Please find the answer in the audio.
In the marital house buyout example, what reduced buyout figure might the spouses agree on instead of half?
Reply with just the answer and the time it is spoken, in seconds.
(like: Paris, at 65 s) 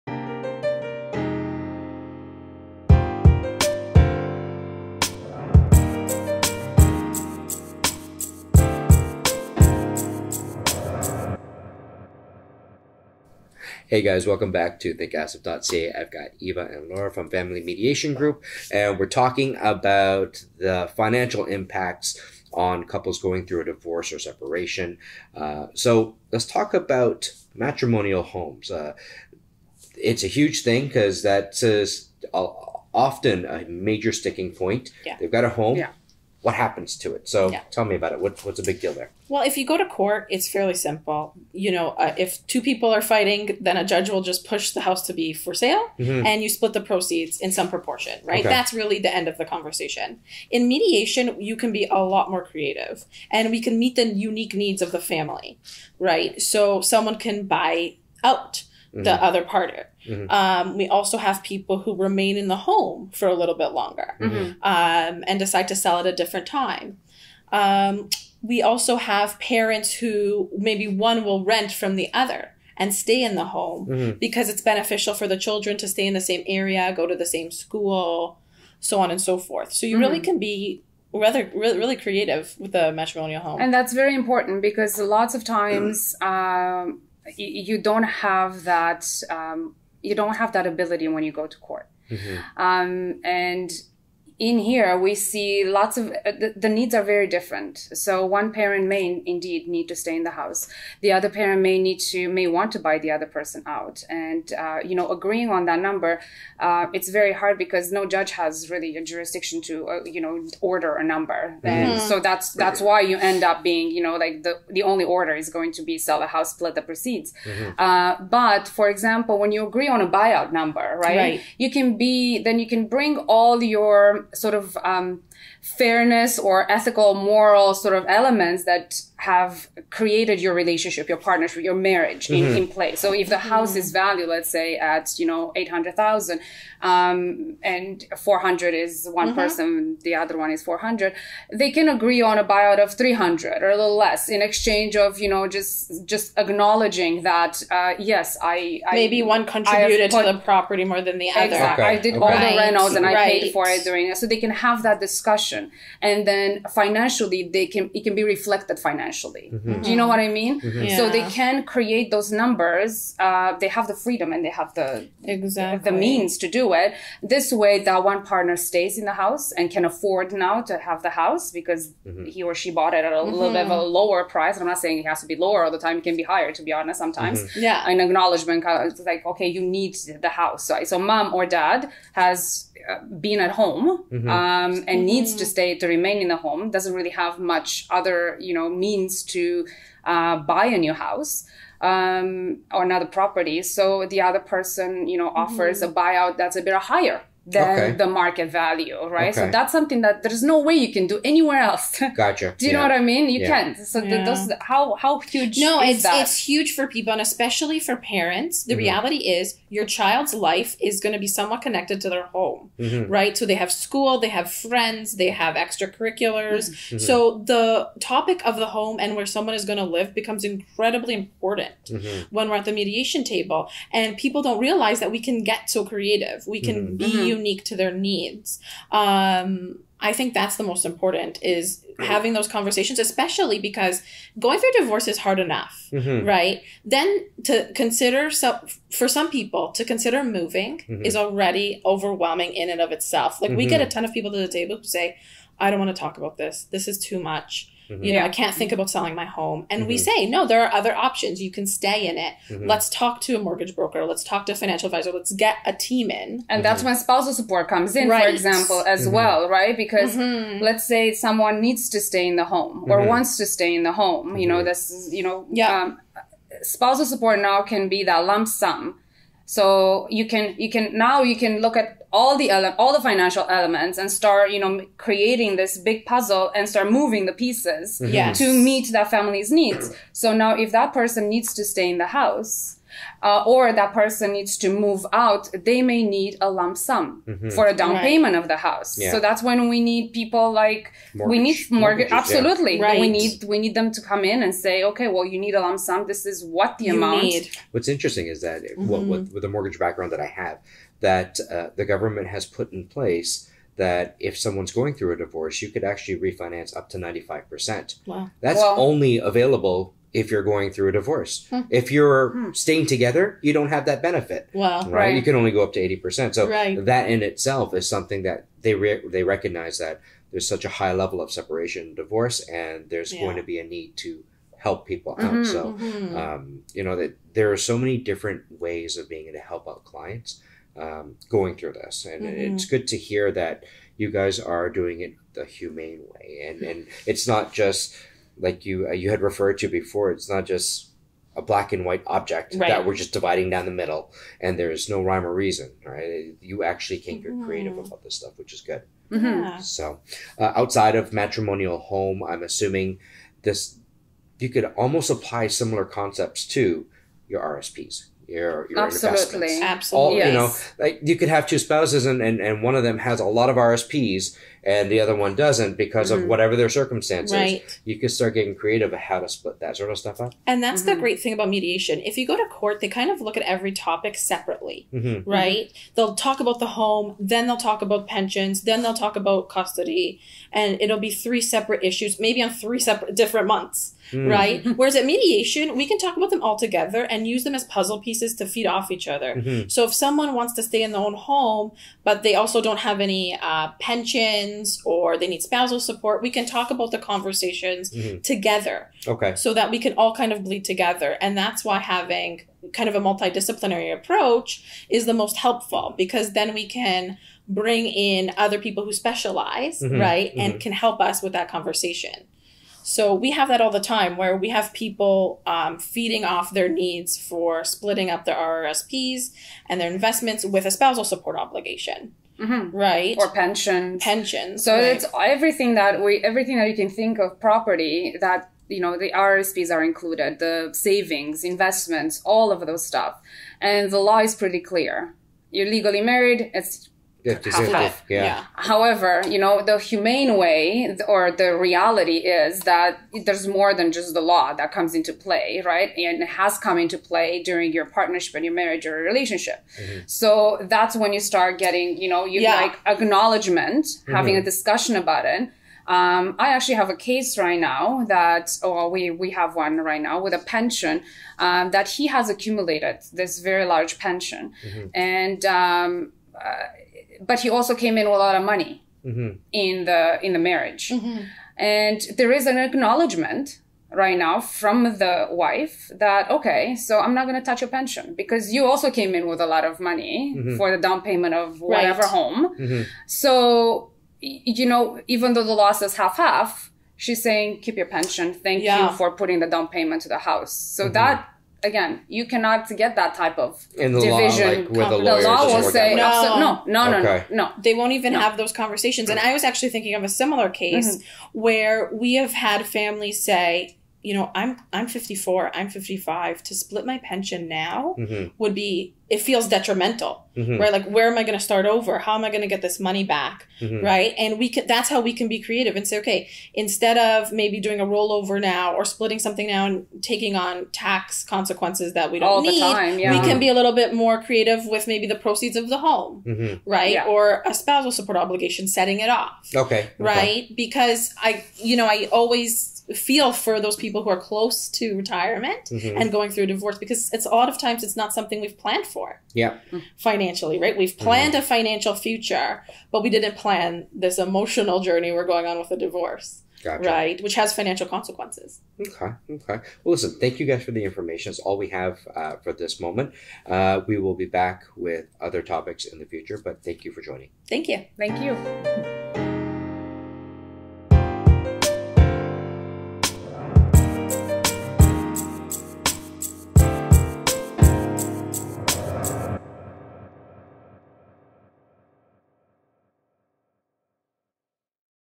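300, at 142 s.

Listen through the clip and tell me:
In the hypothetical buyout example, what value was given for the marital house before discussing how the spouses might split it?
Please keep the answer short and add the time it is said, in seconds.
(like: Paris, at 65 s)
800,000, at 135 s.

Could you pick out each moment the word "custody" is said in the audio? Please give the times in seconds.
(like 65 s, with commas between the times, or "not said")
379 s.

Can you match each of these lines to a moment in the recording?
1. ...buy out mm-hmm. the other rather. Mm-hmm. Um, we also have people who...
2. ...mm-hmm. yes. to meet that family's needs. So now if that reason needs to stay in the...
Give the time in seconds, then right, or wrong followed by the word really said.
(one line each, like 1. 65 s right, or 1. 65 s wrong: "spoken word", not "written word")
1. 57 s wrong: "partner", not "rather"
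2. 277 s wrong: "person", not "reason".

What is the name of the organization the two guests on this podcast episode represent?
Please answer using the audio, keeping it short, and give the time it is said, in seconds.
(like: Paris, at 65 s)
Family Mediation Group, at 17 s.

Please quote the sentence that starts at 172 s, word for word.
he or she bought it at a little bit of a mm-hmm.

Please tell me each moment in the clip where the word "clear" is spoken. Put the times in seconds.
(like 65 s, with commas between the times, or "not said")
434 s.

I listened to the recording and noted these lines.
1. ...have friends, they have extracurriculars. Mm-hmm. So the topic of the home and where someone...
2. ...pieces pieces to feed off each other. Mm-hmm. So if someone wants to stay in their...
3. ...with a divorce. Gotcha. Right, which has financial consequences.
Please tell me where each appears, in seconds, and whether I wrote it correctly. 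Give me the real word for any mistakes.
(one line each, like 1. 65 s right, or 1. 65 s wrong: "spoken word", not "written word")
1. 214 s right
2. 387 s right
3. 545 s right.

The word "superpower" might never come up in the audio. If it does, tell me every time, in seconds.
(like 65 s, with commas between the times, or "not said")
not said.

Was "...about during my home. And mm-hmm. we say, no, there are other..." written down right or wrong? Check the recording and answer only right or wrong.
wrong.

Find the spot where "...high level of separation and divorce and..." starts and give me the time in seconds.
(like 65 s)
320 s.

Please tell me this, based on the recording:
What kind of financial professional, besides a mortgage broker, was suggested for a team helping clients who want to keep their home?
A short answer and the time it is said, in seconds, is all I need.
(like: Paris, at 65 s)
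financial advisor, at 254 s.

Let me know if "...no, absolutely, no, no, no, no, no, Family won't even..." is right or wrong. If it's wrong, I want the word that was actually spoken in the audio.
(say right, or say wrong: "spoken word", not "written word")
wrong: "They", not "Family".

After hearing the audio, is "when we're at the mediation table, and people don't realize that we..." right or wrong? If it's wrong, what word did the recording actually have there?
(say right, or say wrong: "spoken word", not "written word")
right.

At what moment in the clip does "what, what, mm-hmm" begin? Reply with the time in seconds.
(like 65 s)
298 s.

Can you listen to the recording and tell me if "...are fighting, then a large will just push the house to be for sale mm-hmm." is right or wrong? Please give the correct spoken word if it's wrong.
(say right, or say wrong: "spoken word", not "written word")
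wrong: "judge", not "large".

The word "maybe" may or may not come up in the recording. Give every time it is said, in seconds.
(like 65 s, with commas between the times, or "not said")
70 s, 148 s, 382 s, 517 s, 524 s.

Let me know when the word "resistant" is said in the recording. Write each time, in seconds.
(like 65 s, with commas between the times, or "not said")
not said.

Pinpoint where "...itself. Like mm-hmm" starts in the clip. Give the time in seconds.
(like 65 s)
242 s.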